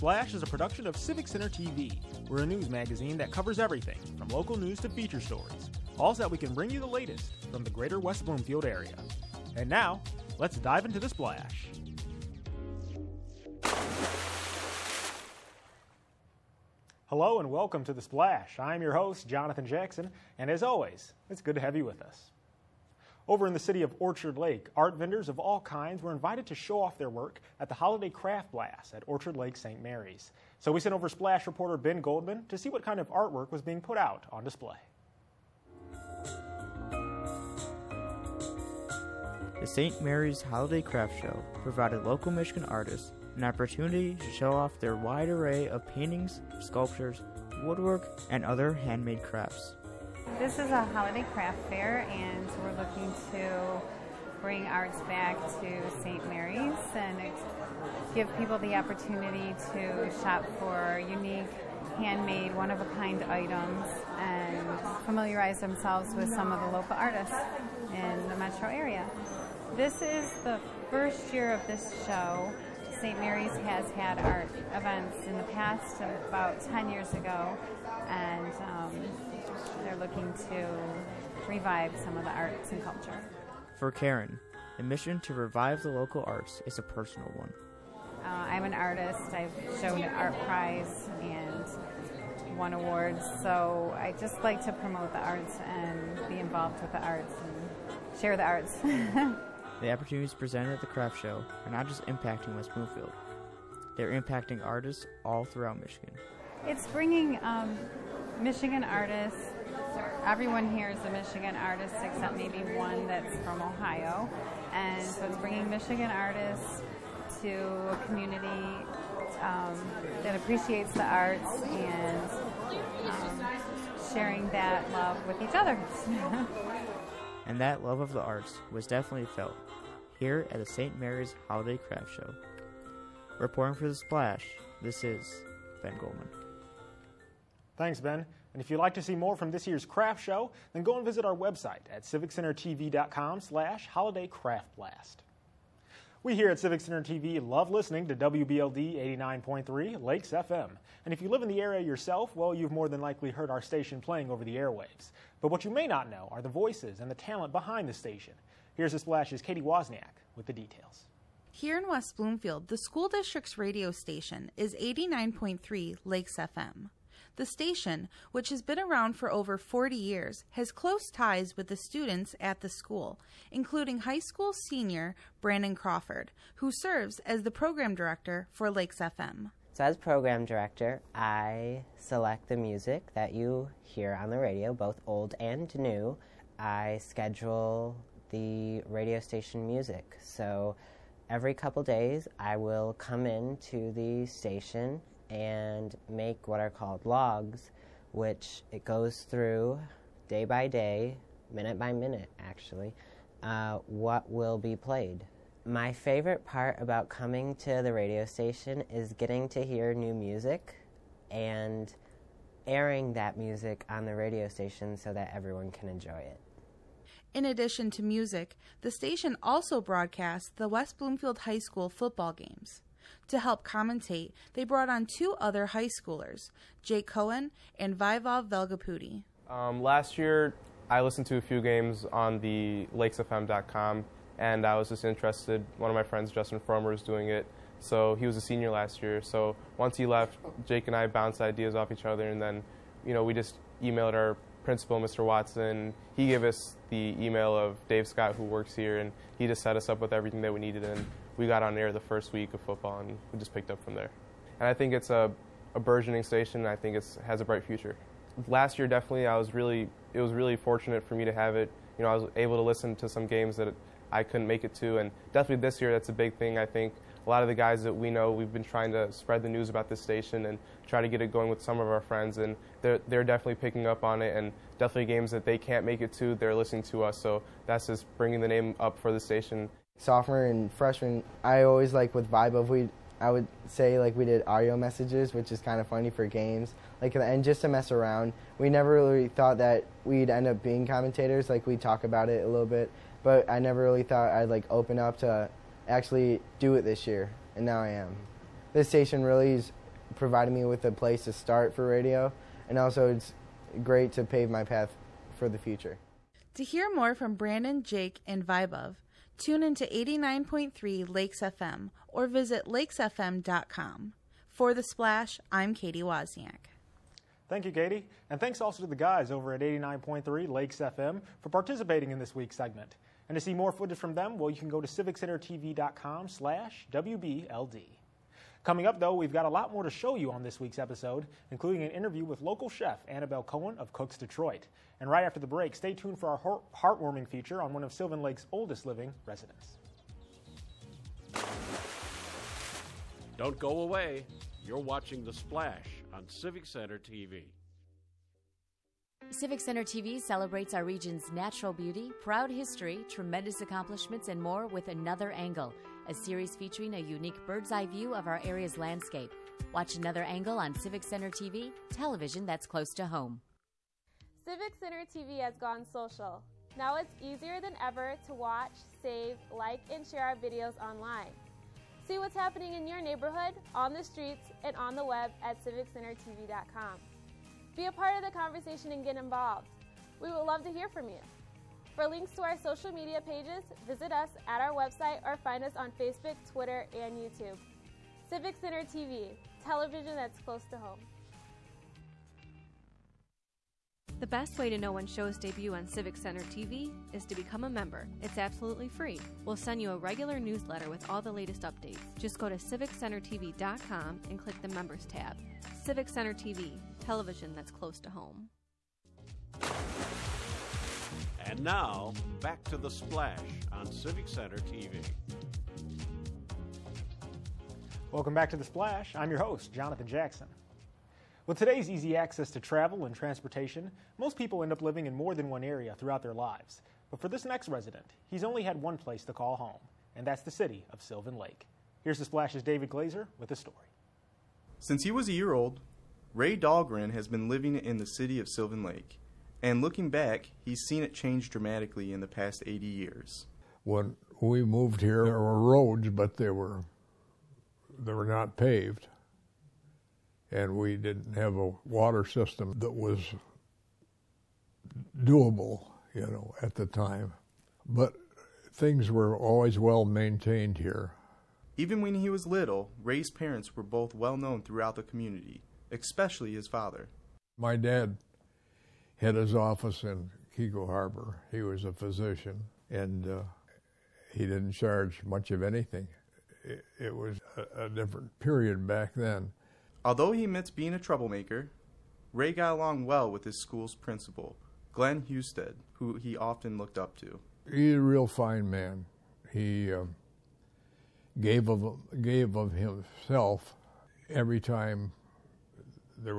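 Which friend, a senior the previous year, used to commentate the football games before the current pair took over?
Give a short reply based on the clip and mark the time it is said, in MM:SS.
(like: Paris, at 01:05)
Justin Fromer, at 03:56.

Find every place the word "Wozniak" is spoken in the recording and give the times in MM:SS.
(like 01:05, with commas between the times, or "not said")
02:39, 05:16.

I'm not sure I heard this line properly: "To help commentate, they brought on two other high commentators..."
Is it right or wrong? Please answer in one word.
wrong.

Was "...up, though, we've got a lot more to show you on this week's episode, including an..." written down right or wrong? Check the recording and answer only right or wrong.
right.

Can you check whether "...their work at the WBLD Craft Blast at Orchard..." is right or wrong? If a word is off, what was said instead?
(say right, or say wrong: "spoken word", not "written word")
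wrong: "Holiday", not "WBLD".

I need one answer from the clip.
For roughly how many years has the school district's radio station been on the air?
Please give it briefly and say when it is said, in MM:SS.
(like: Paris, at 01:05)
40, at 02:49.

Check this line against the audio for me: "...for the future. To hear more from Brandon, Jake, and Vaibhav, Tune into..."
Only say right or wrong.
right.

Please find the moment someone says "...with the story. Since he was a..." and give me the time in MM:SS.
07:13.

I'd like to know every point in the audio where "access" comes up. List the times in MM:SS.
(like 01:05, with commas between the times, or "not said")
07:02.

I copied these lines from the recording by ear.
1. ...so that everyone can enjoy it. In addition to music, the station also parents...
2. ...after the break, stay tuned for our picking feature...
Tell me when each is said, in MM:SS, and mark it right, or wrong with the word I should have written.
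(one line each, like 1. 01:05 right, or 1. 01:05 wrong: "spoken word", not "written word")
1. 03:34 wrong: "broadcasts", not "parents"
2. 05:35 wrong: "heartwarming", not "picking".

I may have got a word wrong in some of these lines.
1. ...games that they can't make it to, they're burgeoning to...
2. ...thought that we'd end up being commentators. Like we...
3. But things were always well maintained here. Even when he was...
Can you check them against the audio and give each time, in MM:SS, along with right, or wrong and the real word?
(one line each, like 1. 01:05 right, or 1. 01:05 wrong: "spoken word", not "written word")
1. 04:35 wrong: "listening", not "burgeoning"
2. 04:49 right
3. 07:37 right.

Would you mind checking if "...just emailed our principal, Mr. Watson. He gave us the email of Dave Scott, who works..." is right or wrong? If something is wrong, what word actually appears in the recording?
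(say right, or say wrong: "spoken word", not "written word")
right.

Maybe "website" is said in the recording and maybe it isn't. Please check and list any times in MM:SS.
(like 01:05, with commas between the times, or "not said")
02:21, 06:24.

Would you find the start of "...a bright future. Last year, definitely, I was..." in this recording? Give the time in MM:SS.
04:17.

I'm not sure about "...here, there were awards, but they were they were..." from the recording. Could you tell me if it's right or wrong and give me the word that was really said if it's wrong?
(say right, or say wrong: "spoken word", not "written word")
wrong: "roads", not "awards".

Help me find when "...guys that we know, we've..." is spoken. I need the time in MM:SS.
04:27.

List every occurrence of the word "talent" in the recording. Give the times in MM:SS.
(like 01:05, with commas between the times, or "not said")
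02:37.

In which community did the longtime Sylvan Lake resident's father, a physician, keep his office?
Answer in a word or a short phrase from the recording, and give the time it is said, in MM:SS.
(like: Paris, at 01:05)
Keego Harbor, at 07:50.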